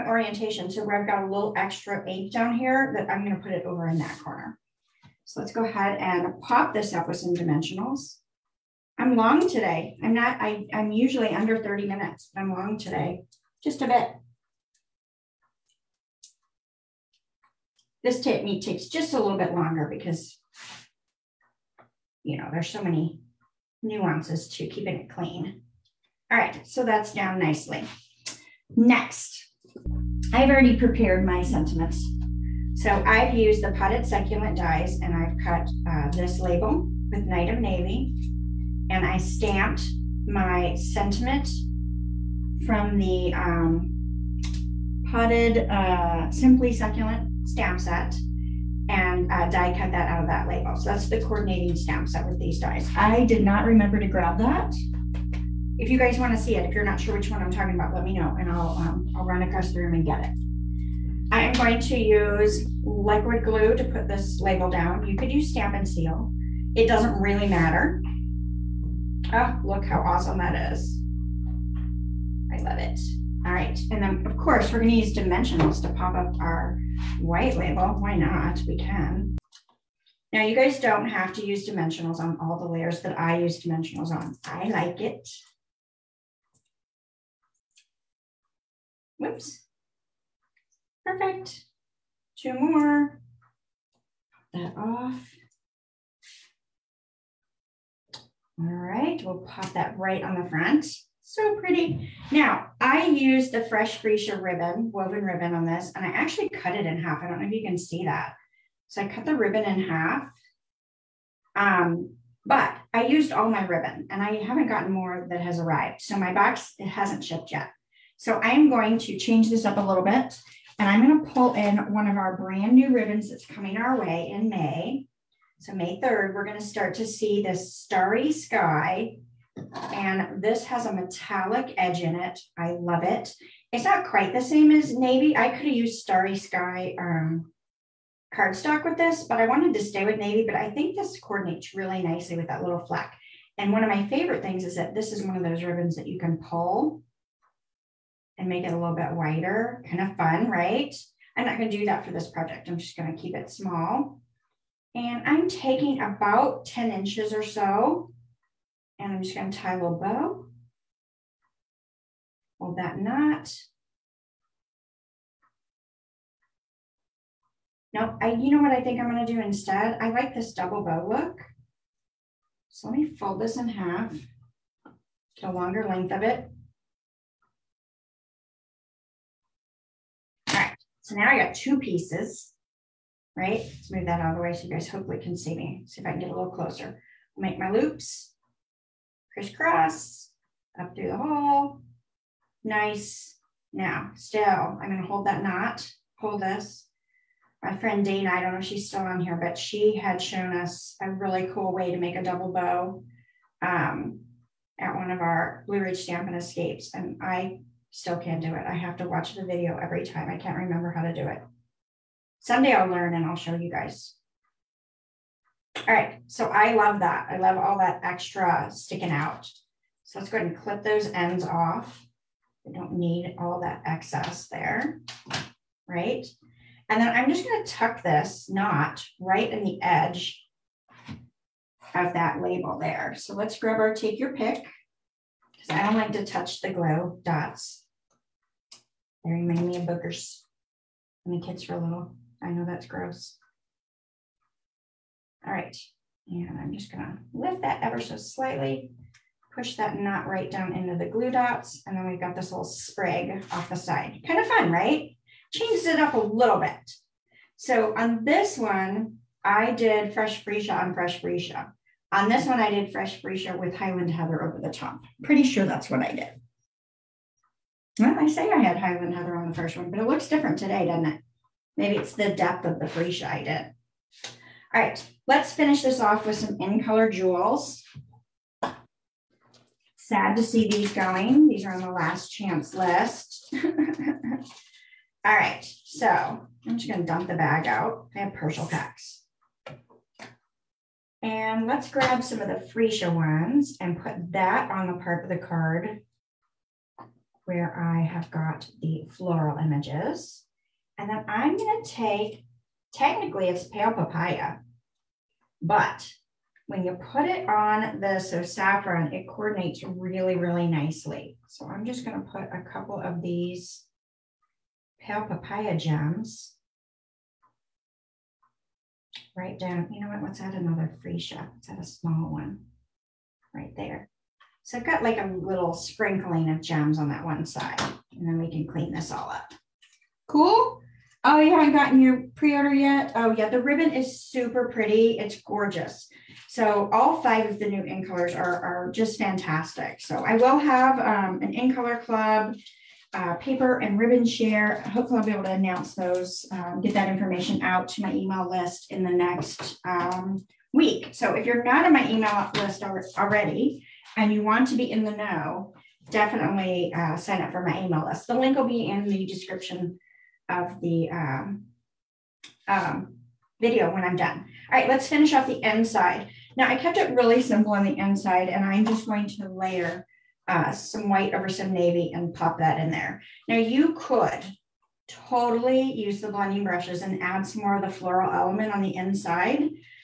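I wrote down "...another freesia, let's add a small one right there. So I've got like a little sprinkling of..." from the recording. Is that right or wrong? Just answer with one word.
right.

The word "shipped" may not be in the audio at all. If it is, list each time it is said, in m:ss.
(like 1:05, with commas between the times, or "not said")
1:57.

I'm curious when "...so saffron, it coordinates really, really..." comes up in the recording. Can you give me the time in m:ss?
5:08.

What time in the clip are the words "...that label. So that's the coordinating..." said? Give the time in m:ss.
0:50.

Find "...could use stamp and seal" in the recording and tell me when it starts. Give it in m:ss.
1:05.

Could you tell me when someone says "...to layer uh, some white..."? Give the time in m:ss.
6:09.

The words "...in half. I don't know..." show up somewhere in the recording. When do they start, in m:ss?
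1:46.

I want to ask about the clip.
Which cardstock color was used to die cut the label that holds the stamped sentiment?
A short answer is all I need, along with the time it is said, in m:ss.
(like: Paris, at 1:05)
Night of Navy, at 0:37.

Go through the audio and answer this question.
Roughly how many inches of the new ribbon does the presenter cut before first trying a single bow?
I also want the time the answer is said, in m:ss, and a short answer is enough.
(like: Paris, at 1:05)
10 inches, at 2:36.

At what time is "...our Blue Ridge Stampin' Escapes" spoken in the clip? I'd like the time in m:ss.
3:25.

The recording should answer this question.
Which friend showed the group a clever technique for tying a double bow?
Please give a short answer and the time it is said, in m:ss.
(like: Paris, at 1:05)
Dana, at 3:18.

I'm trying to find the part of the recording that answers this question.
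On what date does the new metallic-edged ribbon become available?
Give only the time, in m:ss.
2:05.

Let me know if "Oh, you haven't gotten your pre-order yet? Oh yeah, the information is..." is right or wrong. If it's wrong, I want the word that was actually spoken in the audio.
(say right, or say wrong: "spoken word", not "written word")
wrong: "ribbon", not "information".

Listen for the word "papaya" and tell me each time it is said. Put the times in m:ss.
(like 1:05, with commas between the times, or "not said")
5:03, 5:15.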